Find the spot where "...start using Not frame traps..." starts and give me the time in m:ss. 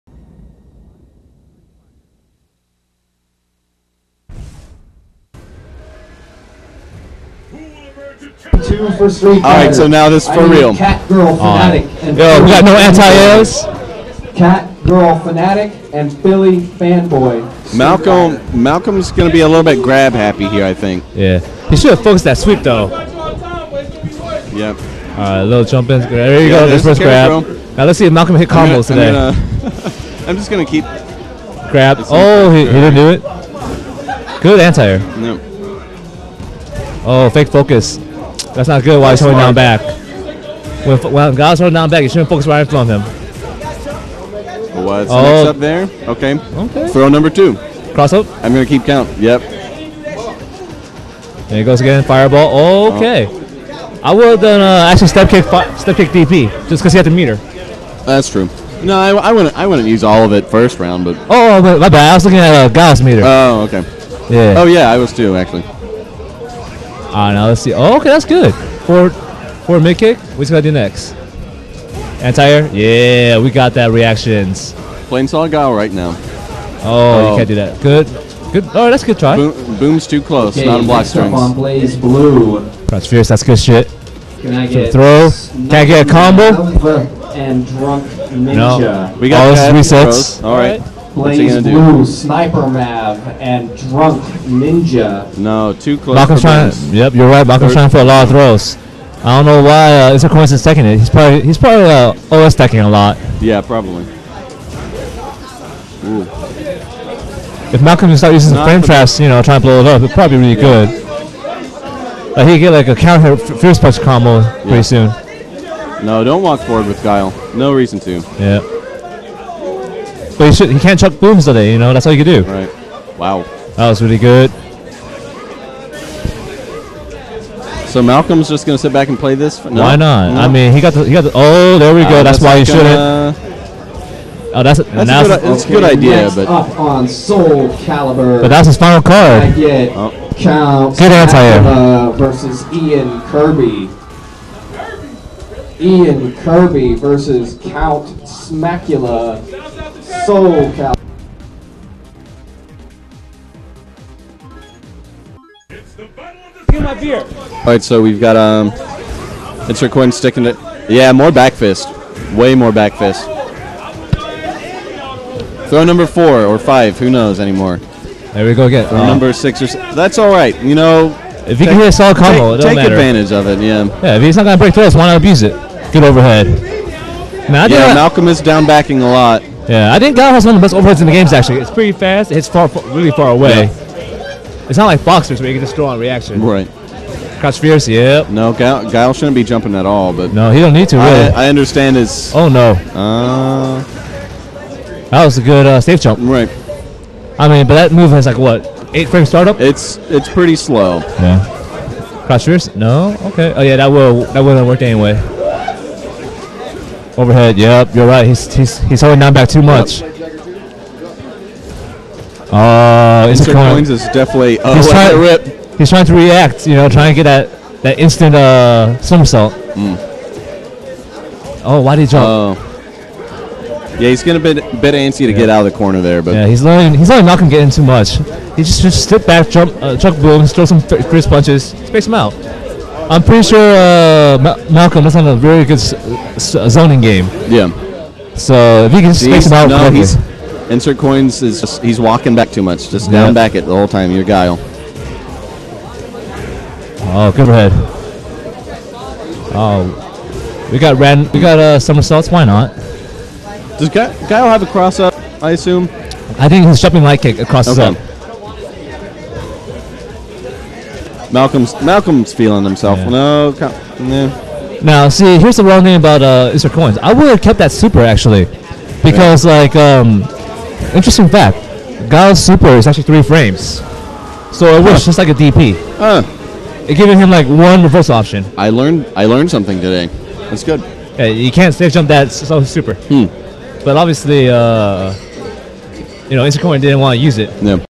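1:48.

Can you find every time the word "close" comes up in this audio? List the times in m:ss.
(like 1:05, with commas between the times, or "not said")
1:20, 1:35.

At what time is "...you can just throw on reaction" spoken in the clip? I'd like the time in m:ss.
3:05.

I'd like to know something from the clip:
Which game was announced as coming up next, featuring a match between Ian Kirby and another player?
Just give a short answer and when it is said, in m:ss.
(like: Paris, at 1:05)
Soulcalibur, at 2:17.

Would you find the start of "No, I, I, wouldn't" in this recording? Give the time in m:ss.
0:58.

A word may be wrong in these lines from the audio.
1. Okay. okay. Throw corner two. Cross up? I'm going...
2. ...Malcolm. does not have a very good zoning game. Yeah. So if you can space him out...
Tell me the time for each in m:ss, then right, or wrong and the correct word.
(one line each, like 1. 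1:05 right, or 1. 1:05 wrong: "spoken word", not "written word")
1. 0:46 wrong: "number", not "corner"
2. 3:54 right.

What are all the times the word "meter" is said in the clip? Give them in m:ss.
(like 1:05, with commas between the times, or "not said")
0:57, 1:03.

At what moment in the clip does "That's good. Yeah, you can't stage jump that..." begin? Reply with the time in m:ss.
4:40.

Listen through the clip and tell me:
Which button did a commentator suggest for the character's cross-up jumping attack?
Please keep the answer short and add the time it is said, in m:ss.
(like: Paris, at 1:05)
light kick, at 4:17.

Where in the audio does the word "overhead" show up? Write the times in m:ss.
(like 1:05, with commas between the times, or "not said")
2:56, 3:00, 3:27.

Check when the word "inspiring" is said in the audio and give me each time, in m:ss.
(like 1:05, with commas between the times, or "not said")
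not said.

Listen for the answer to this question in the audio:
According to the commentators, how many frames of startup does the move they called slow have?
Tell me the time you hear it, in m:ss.
3:18.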